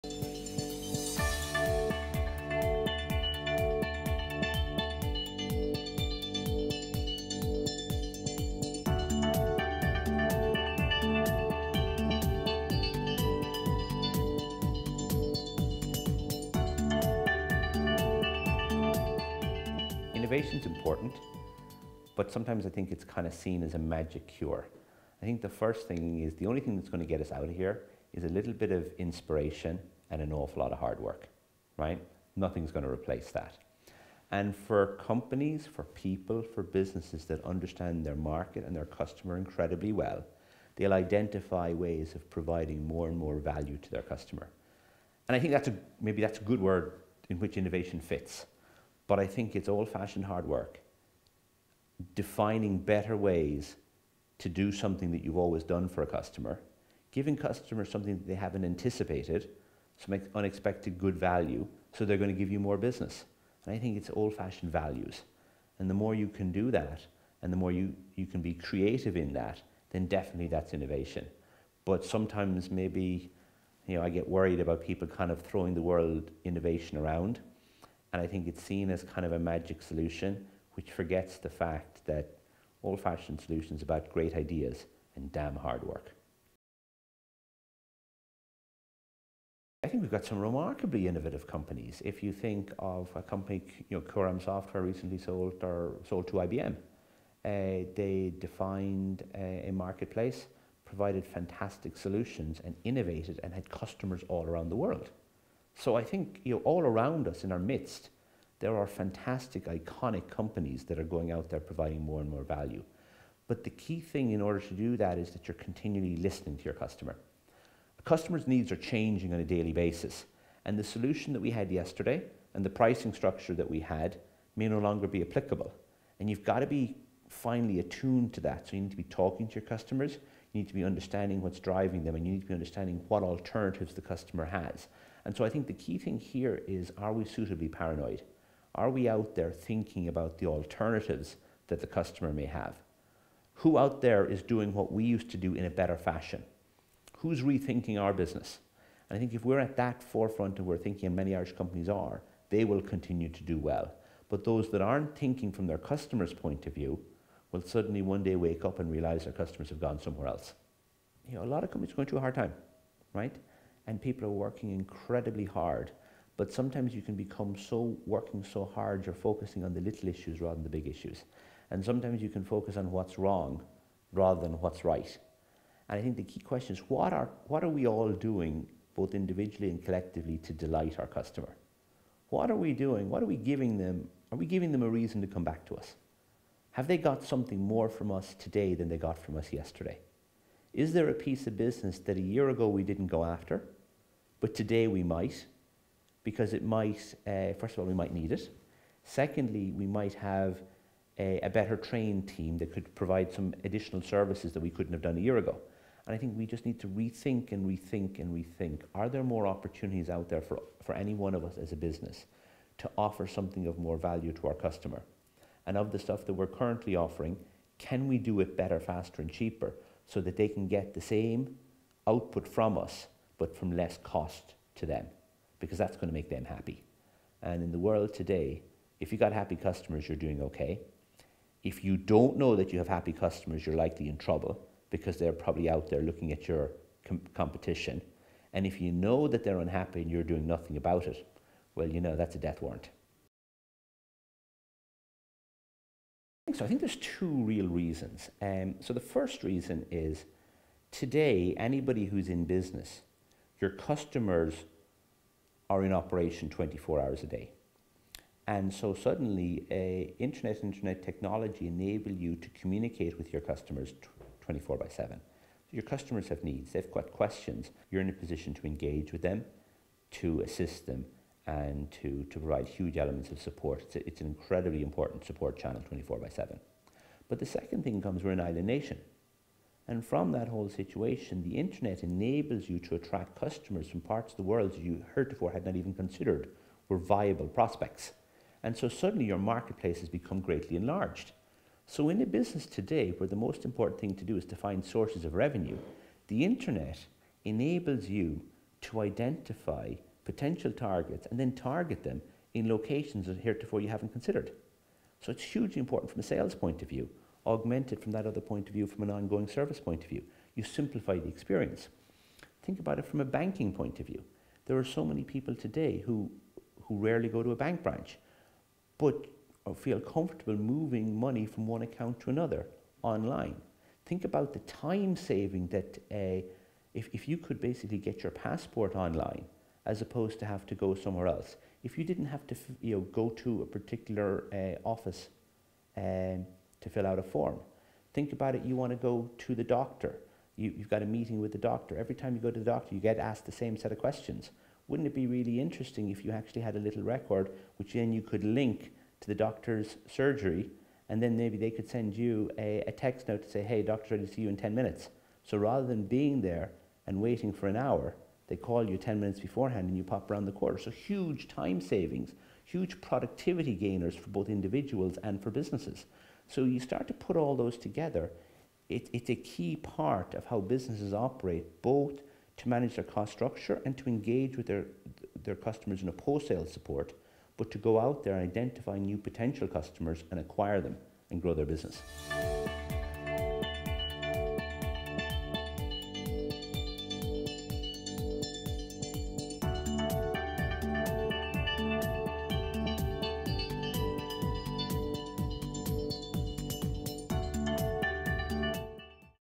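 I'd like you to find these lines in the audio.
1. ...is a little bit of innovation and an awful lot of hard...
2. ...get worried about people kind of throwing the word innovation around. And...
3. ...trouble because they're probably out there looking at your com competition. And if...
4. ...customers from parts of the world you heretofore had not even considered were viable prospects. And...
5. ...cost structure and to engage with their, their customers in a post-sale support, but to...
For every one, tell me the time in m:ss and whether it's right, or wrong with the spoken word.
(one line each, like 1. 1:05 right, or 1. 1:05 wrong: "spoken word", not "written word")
1. 0:28 wrong: "inspiration", not "innovation"
2. 1:14 right
3. 3:54 right
4. 4:43 right
5. 6:13 right.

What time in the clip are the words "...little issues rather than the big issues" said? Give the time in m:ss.
2:49.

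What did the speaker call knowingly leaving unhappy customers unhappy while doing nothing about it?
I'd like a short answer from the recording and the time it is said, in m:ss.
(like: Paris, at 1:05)
a death warrant, at 4:02.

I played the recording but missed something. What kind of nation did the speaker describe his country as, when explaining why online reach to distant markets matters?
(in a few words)
an island nation.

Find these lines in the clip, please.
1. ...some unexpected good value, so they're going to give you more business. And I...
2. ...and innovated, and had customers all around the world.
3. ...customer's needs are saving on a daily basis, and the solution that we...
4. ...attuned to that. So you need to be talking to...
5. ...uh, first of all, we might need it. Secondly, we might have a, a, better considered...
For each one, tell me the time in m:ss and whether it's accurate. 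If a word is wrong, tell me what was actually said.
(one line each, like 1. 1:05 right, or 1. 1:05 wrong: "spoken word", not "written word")
1. 0:59 right
2. 1:42 right
3. 1:58 wrong: "changing", not "saving"
4. 2:07 right
5. 3:17 wrong: "trained", not "considered".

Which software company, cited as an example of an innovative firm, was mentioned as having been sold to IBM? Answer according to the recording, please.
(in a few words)
Cúram Software.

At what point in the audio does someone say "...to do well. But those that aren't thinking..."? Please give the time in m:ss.
2:33.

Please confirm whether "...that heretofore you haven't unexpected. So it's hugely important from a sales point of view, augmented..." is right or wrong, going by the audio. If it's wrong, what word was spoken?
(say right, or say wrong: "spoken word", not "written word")
wrong: "considered", not "unexpected".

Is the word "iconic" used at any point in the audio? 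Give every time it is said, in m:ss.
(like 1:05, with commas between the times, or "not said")
1:49.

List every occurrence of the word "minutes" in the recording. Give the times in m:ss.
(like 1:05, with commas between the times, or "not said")
5:54, 5:59.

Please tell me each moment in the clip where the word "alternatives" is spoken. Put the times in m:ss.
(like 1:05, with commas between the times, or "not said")
2:13, 2:20.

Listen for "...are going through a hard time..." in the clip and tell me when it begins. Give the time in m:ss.
2:41.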